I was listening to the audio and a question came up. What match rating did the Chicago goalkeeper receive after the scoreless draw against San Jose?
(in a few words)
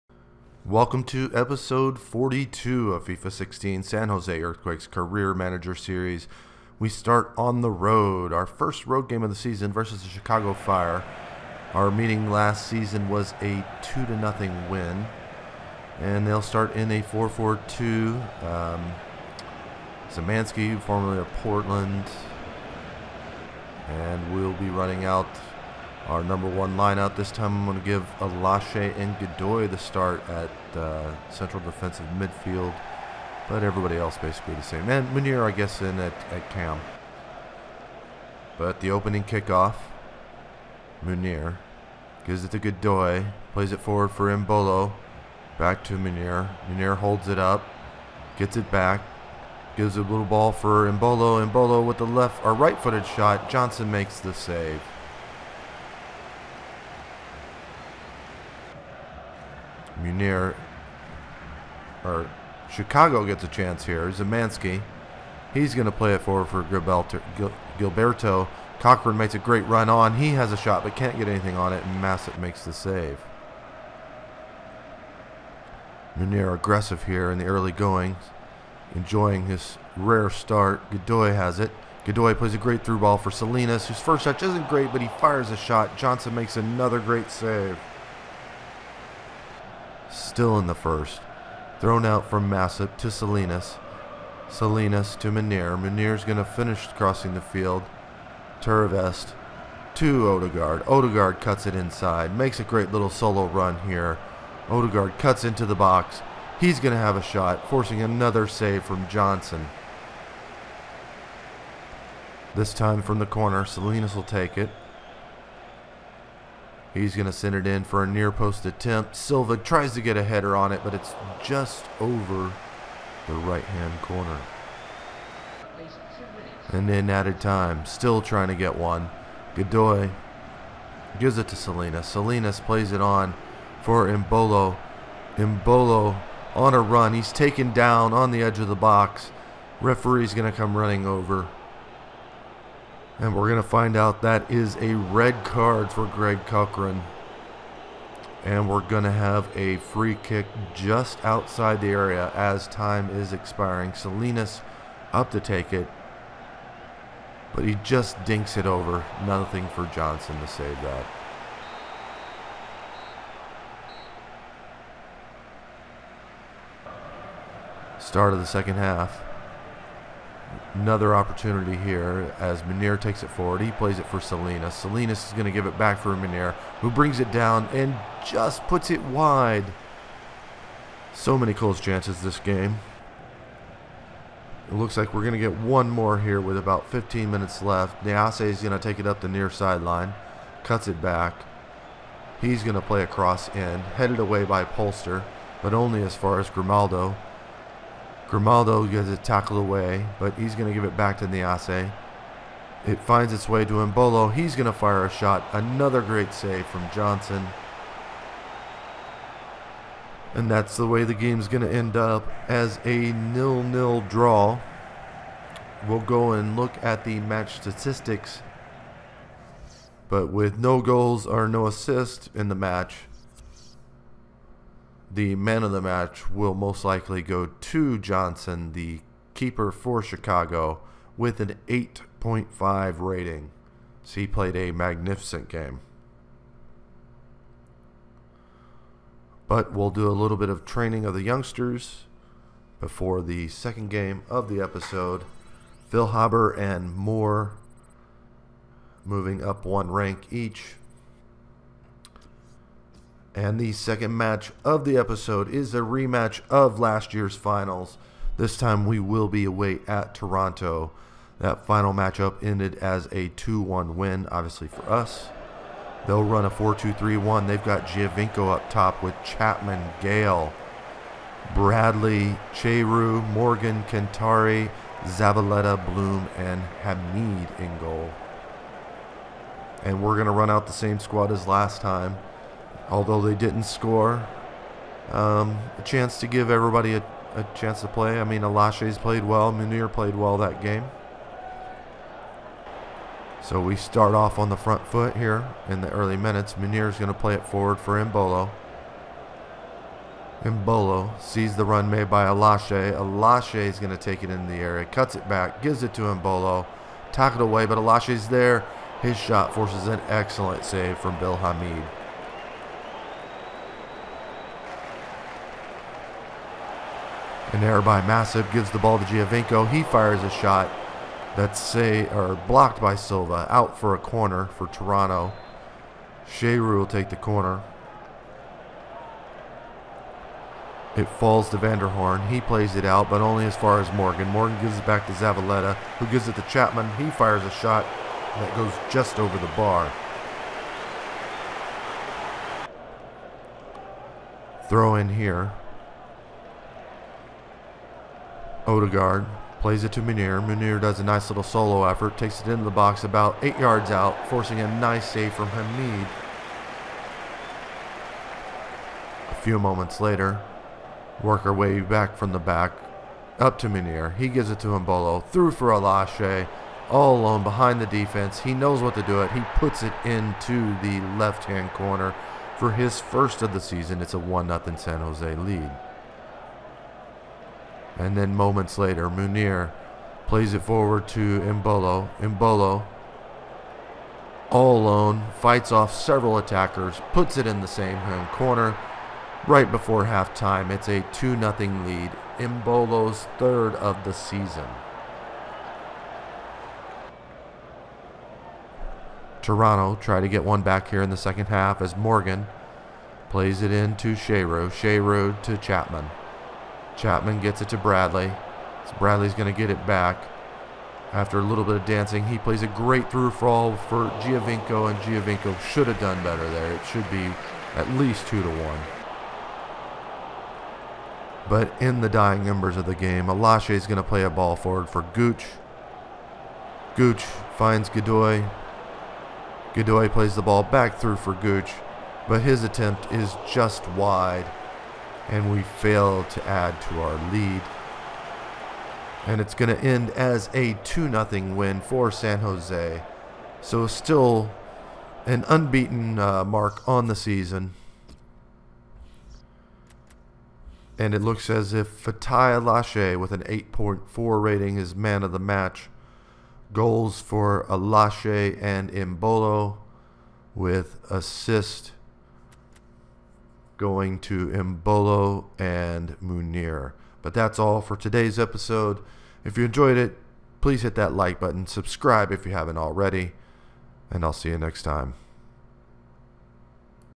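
8.5.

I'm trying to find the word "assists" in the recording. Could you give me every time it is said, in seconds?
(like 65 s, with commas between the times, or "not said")
221 s, 461 s.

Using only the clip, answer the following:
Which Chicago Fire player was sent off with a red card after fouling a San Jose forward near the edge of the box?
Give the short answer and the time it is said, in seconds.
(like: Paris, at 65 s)
Greg Cochrane, at 146 s.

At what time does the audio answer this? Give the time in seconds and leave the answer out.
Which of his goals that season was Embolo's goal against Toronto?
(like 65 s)
393 s.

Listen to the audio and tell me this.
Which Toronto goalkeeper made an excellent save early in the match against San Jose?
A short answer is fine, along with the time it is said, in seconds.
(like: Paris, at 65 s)
Bill Hamid, at 311 s.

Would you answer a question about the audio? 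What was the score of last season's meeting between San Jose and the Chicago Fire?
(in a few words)
2-0.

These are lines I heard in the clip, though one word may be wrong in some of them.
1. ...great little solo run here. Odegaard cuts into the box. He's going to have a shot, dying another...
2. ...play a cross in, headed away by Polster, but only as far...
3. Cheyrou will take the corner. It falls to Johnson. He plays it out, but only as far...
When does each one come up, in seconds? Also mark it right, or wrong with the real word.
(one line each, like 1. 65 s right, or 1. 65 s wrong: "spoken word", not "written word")
1. 102 s wrong: "forcing", not "dying"
2. 192 s right
3. 326 s wrong: "Vanderhorn", not "Johnson".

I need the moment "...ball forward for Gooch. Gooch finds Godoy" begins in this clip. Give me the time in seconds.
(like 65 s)
424 s.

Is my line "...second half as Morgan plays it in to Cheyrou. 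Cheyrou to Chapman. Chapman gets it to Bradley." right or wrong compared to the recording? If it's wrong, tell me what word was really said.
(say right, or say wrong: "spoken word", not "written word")
right.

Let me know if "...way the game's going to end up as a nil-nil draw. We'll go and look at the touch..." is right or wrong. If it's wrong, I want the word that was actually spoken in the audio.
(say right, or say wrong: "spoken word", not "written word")
wrong: "match", not "touch".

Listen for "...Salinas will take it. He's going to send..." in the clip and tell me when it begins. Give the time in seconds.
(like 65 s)
113 s.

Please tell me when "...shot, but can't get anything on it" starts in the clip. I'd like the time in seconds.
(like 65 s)
70 s.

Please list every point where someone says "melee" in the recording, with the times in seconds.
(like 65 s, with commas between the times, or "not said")
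not said.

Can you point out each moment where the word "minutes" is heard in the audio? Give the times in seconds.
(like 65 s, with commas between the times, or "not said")
187 s, 296 s.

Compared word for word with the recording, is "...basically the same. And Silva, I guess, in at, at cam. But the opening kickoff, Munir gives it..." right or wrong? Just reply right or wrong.
wrong.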